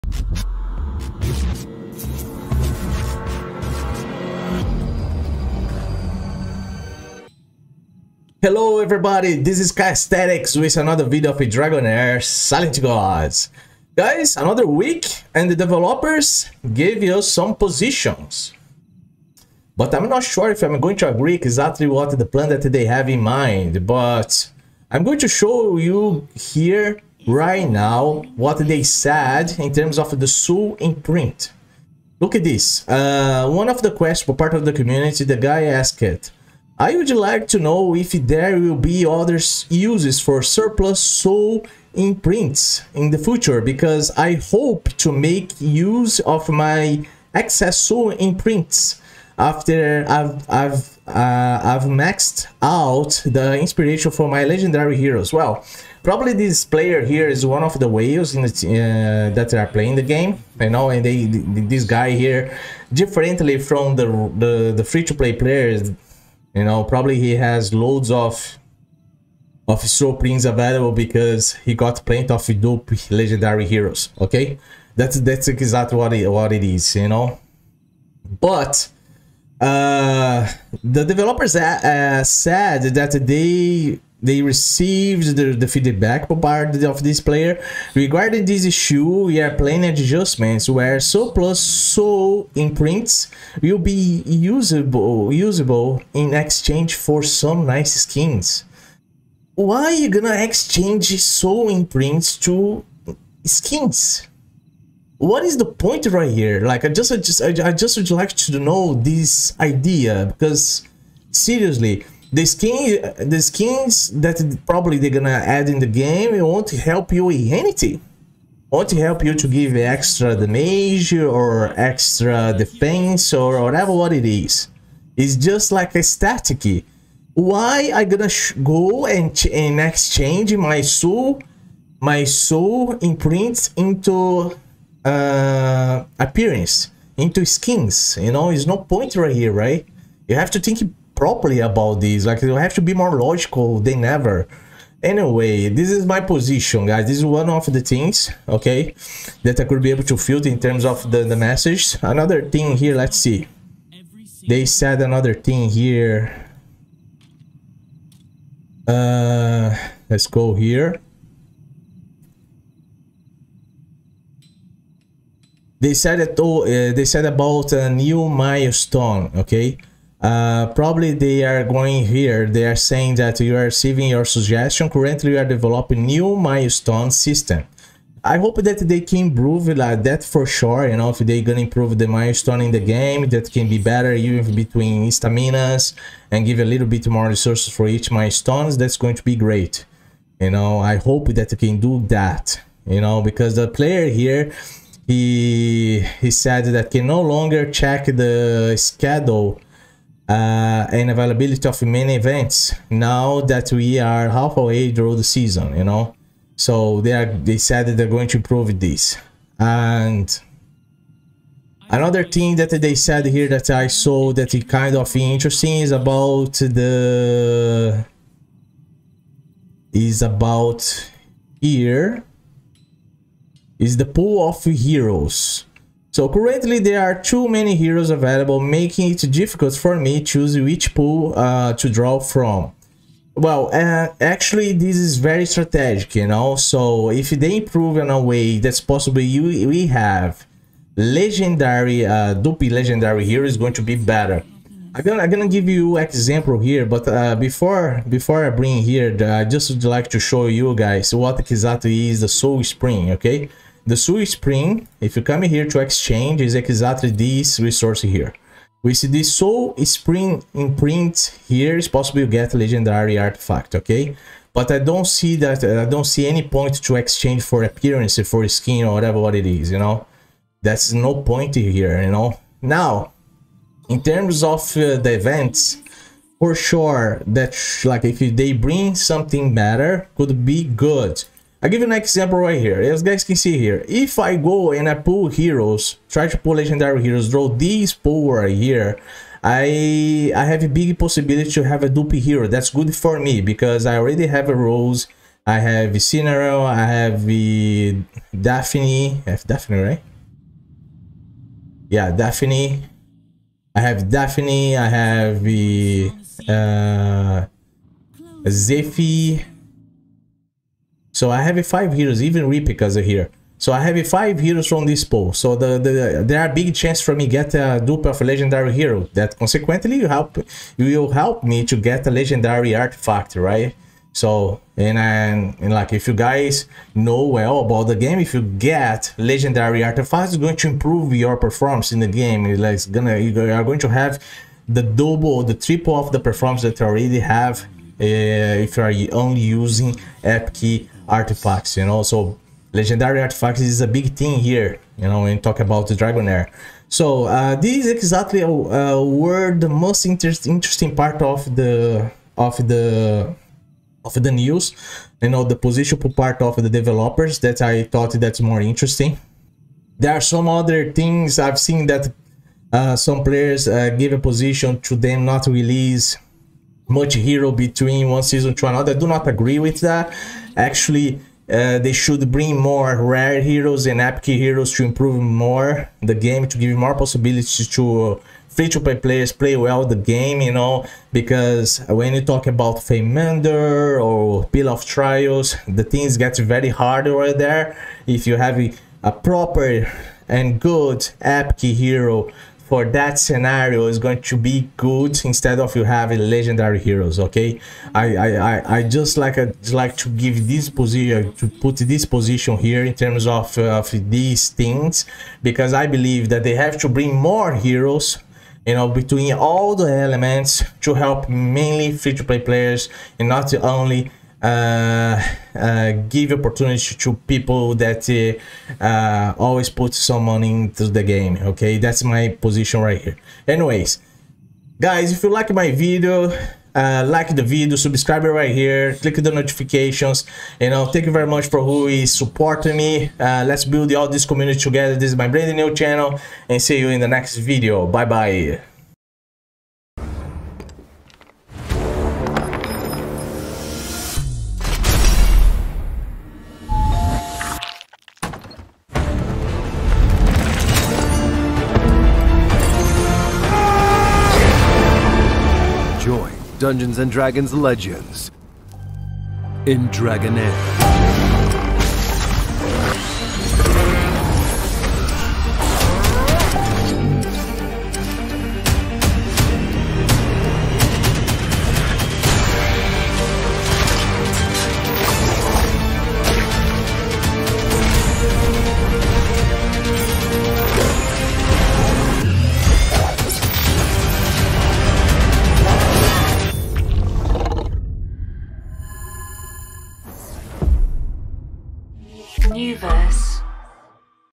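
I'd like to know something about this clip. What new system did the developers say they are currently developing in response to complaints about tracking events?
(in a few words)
Milestone system.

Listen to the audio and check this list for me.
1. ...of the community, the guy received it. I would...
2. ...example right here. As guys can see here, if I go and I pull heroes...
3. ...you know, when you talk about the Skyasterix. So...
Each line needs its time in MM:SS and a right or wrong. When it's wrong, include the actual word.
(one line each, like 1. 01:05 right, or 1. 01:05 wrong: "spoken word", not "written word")
1. 00:34 wrong: "asked", not "received"
2. 04:41 right
3. 05:44 wrong: "Dragonheir", not "Skyasterix".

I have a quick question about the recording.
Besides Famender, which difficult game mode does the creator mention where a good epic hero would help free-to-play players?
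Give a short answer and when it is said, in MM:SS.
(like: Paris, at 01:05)
Pill of Trials, at 06:24.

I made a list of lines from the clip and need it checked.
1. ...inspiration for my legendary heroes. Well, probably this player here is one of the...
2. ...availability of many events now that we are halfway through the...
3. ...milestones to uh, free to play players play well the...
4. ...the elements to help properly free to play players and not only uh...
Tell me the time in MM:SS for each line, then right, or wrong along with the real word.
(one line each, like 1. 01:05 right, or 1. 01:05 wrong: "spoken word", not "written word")
1. 00:53 right
2. 03:21 right
3. 06:16 wrong: "possibilities", not "milestones"
4. 06:49 wrong: "mainly", not "properly".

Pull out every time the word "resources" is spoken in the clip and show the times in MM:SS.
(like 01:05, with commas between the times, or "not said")
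03:07, 04:17.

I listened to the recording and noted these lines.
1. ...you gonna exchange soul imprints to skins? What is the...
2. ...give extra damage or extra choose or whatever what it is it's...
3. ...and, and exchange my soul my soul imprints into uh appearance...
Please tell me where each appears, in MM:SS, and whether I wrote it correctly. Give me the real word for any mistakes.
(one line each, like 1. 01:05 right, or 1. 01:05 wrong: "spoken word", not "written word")
1. 01:39 right
2. 01:59 wrong: "defense", not "choose"
3. 02:09 right.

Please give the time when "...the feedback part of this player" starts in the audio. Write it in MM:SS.
01:25.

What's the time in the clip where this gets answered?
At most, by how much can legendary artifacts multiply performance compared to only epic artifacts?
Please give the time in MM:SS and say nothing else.
05:35.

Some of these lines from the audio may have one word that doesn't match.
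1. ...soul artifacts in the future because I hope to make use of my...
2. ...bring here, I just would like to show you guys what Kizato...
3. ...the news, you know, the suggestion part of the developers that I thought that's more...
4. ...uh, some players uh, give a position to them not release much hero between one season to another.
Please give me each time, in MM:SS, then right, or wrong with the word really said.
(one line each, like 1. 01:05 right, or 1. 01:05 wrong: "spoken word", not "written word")
1. 00:40 wrong: "imprints", not "artifacts"
2. 04:08 right
3. 05:54 wrong: "position", not "suggestion"
4. 06:02 right.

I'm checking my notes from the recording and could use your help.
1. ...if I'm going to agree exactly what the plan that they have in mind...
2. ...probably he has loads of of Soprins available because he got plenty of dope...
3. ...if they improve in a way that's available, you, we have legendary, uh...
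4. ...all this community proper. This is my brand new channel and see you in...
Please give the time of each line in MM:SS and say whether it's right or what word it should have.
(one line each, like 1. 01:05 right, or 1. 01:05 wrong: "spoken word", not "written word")
1. 00:20 right
2. 01:06 right
3. 03:57 wrong: "possible", not "available"
4. 07:13 wrong: "together", not "proper".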